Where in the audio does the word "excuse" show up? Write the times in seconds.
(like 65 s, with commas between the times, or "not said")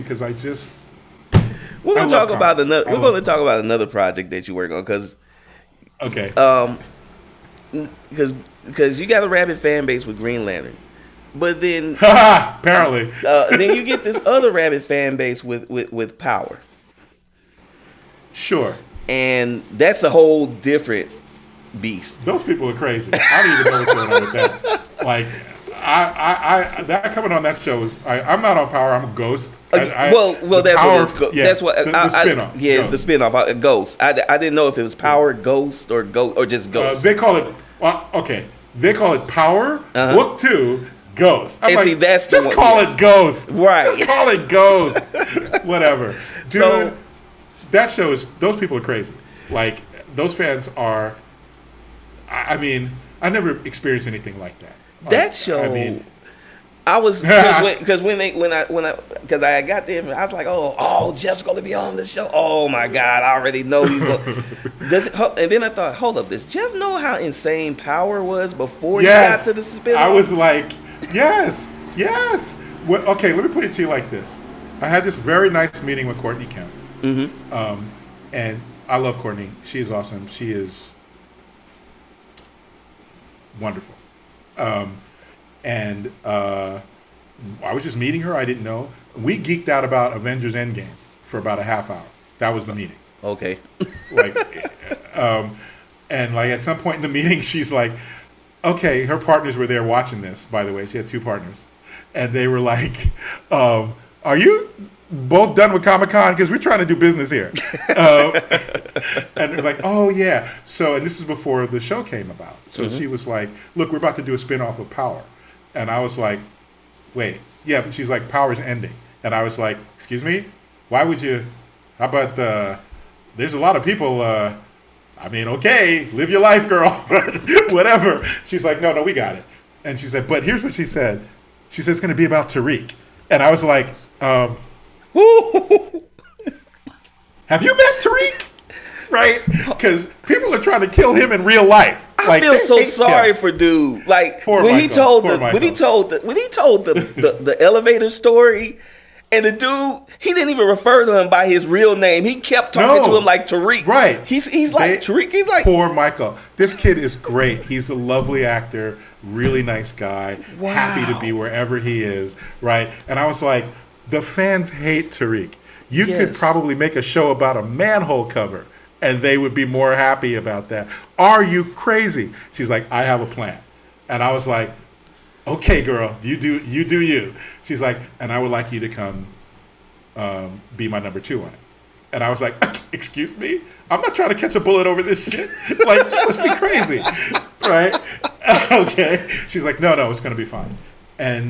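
119 s, 182 s.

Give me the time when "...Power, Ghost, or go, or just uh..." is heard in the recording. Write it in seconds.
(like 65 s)
34 s.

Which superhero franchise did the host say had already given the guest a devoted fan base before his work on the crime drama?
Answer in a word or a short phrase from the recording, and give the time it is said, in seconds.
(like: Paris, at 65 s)
Green Lantern, at 10 s.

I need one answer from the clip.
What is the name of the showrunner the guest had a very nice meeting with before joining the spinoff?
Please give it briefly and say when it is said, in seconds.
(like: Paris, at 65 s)
Courtney Kemp, at 76 s.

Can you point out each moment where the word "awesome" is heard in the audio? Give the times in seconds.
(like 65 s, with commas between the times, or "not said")
79 s.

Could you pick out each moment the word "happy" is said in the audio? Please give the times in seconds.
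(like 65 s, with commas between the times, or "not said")
160 s, 169 s.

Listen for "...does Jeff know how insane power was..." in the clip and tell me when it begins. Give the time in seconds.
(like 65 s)
66 s.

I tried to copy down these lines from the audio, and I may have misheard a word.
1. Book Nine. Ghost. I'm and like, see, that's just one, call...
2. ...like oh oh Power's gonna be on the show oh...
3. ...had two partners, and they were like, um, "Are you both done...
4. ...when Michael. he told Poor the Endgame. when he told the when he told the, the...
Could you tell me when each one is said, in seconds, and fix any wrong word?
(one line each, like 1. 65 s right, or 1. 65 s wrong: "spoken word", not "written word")
1. 40 s wrong: "Two", not "Nine"
2. 60 s wrong: "Jeff", not "Power"
3. 100 s right
4. 144 s wrong: "Michael", not "Endgame".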